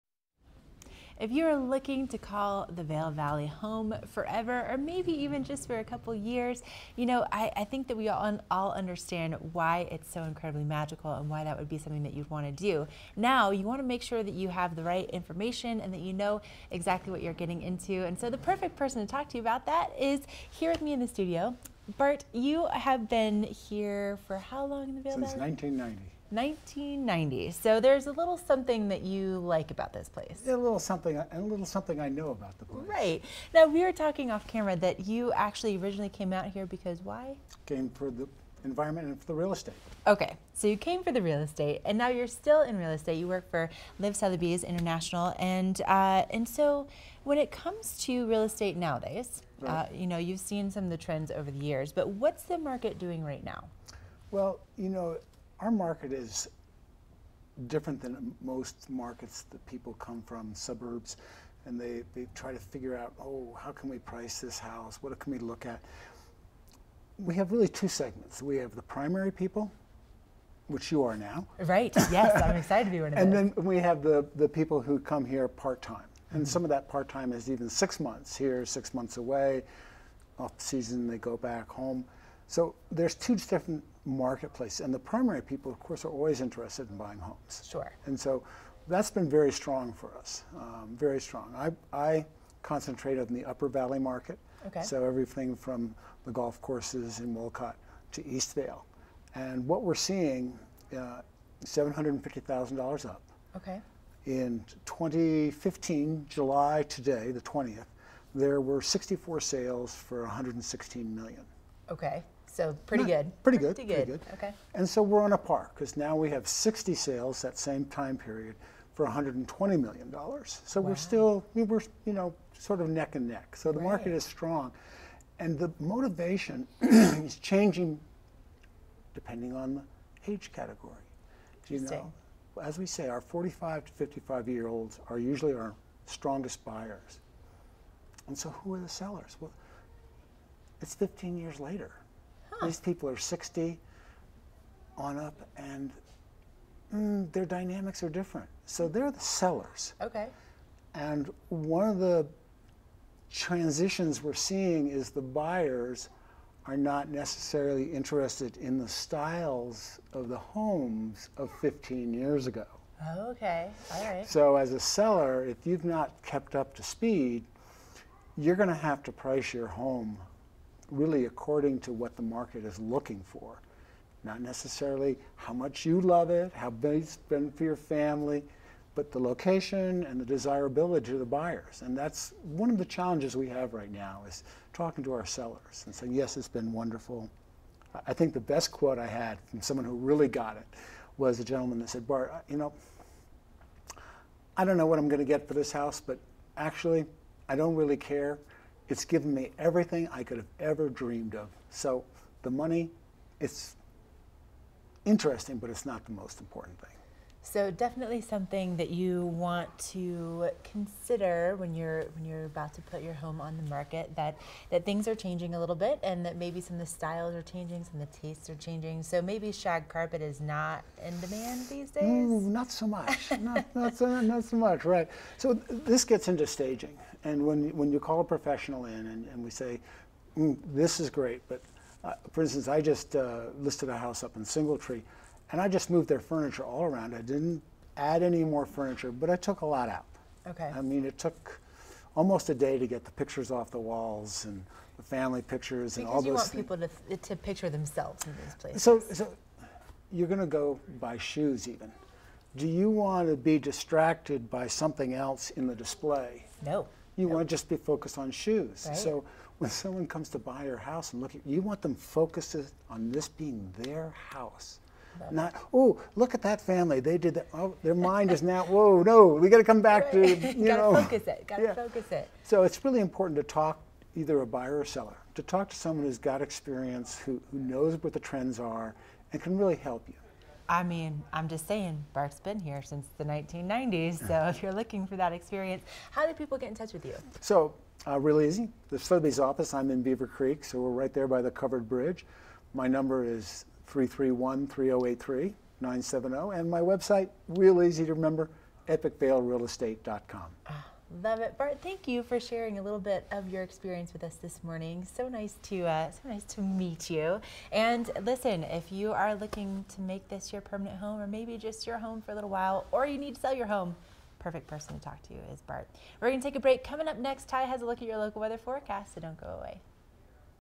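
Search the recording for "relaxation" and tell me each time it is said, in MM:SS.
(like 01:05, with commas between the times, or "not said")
not said.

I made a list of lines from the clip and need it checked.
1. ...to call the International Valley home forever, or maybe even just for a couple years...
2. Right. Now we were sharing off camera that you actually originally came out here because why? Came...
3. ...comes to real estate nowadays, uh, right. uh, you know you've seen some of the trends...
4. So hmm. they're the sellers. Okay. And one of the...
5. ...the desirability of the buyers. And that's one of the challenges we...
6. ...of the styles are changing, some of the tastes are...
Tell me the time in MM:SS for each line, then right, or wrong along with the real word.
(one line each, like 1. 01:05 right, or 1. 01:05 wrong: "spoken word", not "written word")
1. 00:02 wrong: "Vail", not "International"
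2. 00:32 wrong: "talking", not "sharing"
3. 00:47 right
4. 02:28 right
5. 03:00 right
6. 03:36 right.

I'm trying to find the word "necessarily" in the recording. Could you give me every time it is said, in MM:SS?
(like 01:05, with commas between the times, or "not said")
02:37, 02:54.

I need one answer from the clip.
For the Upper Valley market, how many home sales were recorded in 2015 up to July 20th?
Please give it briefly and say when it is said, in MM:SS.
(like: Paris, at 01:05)
64, at 01:48.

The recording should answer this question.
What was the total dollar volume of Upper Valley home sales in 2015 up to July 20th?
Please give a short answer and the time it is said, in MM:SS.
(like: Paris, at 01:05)
$120 million, at 01:59.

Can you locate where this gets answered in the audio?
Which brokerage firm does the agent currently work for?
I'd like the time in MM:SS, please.
00:43.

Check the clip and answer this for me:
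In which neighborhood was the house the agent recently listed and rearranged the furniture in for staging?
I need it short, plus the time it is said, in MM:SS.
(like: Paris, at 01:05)
Singletree, at 03:54.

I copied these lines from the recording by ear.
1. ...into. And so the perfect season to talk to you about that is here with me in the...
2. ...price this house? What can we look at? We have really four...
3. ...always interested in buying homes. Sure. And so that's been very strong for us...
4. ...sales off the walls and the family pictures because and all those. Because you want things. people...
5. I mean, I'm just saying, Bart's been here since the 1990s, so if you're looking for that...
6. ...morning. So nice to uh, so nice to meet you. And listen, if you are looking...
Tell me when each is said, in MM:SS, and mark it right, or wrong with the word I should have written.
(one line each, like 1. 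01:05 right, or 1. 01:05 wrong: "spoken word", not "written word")
1. 00:17 wrong: "person", not "season"
2. 01:03 wrong: "two", not "four"
3. 01:26 right
4. 04:03 wrong: "pictures", not "sales"
5. 04:40 right
6. 05:04 right.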